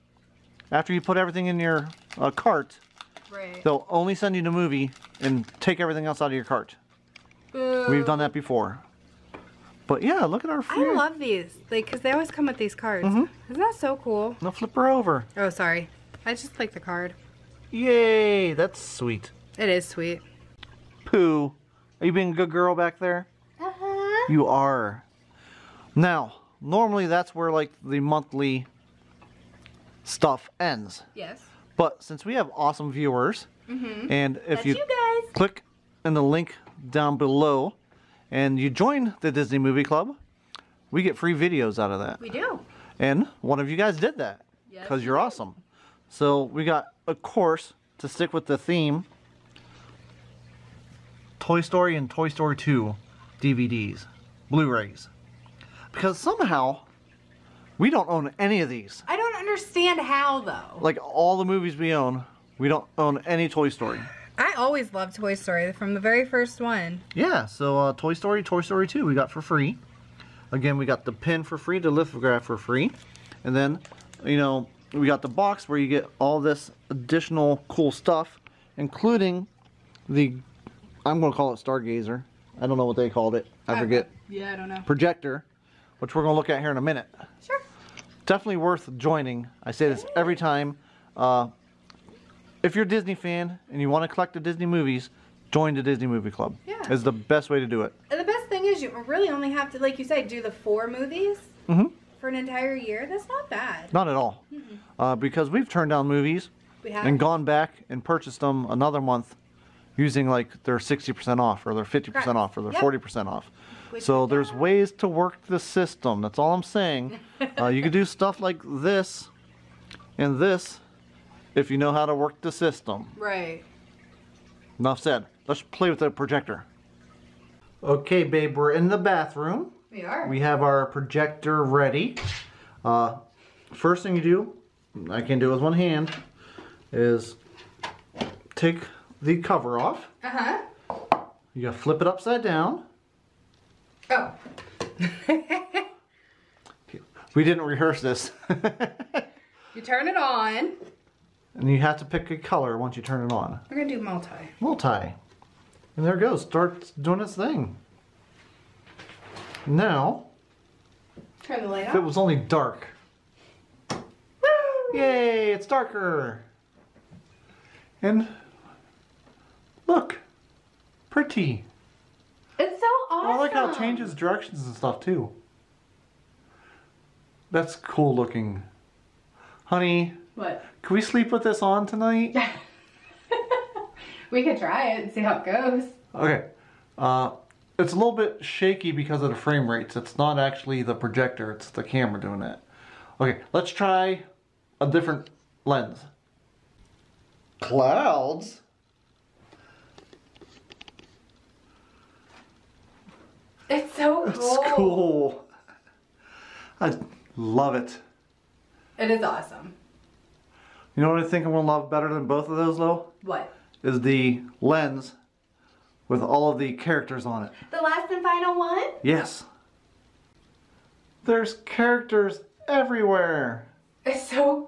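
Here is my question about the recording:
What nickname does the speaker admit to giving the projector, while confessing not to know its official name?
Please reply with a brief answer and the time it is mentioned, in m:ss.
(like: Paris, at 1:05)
Stargazer, at 1:21.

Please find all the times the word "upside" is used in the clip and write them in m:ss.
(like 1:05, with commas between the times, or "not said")
2:22.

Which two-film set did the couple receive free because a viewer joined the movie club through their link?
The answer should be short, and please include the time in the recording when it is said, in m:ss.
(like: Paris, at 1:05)
Toy Story and Toy Story 2, at 0:51.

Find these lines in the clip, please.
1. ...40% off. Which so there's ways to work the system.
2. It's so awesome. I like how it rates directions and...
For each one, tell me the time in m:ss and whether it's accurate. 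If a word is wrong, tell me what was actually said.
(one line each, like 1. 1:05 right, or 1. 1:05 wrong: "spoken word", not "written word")
1. 1:52 right
2. 2:52 wrong: "changes", not "rates".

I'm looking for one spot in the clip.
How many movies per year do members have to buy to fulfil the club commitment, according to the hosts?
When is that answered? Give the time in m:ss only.
1:40.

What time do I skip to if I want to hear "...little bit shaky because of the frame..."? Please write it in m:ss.
3:07.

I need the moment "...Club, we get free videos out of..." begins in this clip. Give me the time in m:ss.
0:39.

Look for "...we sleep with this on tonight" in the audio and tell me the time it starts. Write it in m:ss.
3:00.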